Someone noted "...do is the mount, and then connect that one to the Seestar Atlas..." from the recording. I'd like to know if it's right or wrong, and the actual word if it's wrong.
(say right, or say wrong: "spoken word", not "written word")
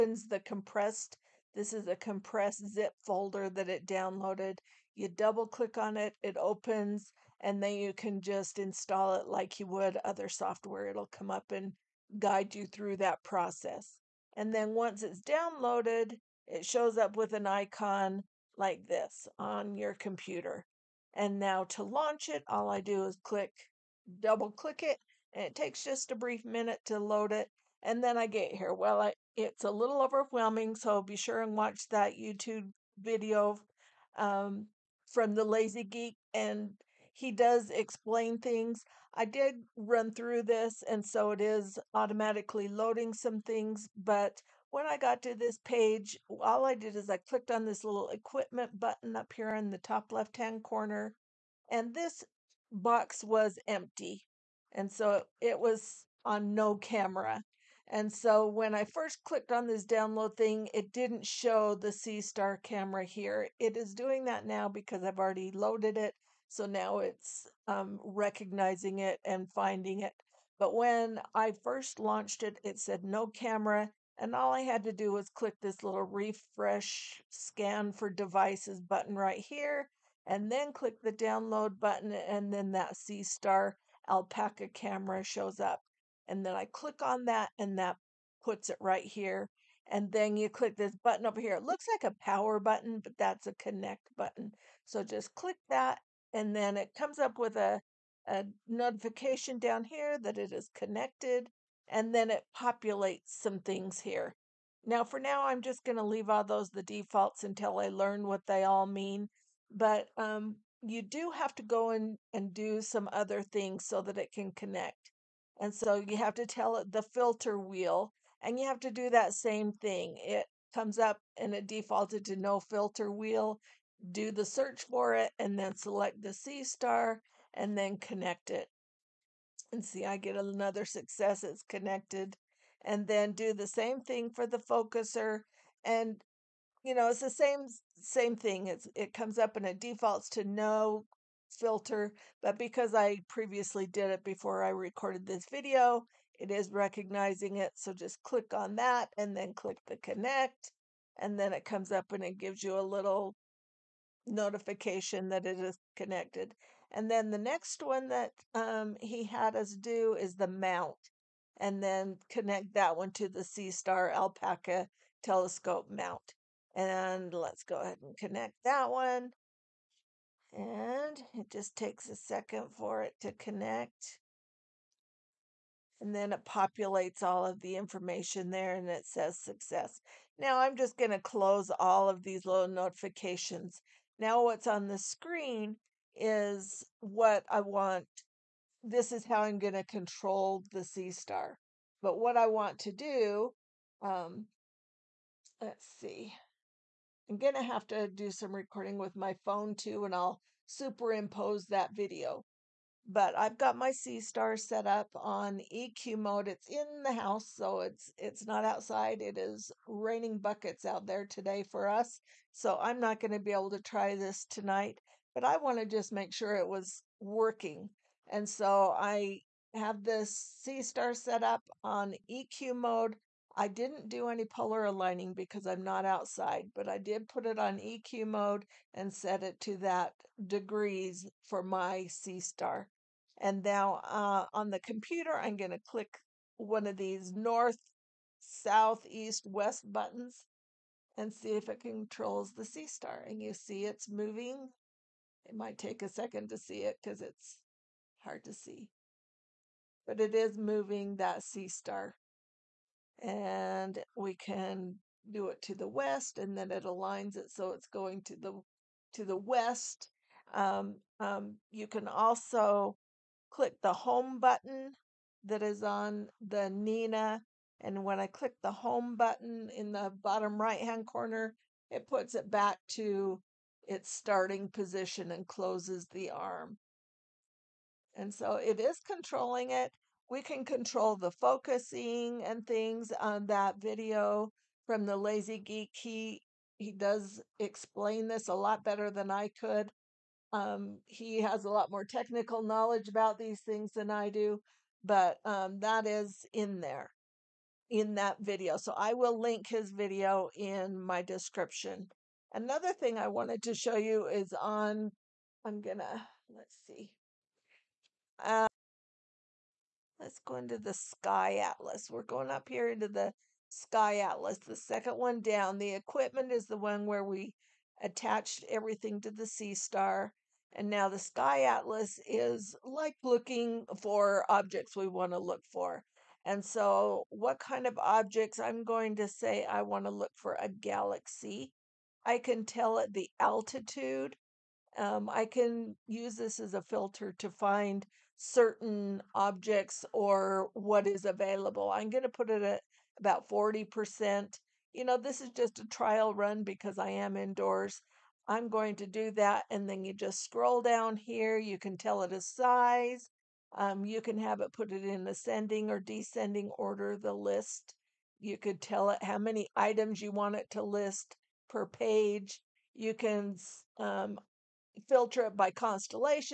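wrong: "Alpaca", not "Atlas".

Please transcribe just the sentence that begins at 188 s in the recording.
This is how I'm going to control the Seestar.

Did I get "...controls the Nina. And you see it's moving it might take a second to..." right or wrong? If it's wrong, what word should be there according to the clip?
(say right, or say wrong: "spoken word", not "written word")
wrong: "Seestar", not "Nina".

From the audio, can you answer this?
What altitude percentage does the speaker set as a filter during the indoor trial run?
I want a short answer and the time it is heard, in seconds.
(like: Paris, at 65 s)
40%, at 343 s.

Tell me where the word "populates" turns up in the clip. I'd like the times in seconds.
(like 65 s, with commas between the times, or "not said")
102 s, 176 s.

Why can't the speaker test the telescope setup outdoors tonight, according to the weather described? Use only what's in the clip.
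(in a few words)
Raining buckets.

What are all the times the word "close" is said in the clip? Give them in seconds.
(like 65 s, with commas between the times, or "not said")
181 s, 275 s.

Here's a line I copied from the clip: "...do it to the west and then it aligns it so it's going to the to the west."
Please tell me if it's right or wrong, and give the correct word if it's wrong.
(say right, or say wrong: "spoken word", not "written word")
right.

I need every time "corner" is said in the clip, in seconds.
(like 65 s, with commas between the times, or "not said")
50 s, 271 s.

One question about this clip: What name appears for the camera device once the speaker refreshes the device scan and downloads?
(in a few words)
Seestar alpaca camera.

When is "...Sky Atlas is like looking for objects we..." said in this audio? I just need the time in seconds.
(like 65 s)
321 s.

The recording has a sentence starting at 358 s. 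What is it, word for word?
You could tell it how many items you want it to list per page.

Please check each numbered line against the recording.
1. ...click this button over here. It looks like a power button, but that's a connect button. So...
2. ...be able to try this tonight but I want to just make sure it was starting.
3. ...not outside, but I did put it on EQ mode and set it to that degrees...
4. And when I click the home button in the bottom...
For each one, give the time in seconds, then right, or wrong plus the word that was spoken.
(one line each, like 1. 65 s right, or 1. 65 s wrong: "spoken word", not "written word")
1. 90 s right
2. 213 s wrong: "working", not "starting"
3. 225 s right
4. 267 s right.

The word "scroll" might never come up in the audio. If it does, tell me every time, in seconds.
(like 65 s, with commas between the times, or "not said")
350 s.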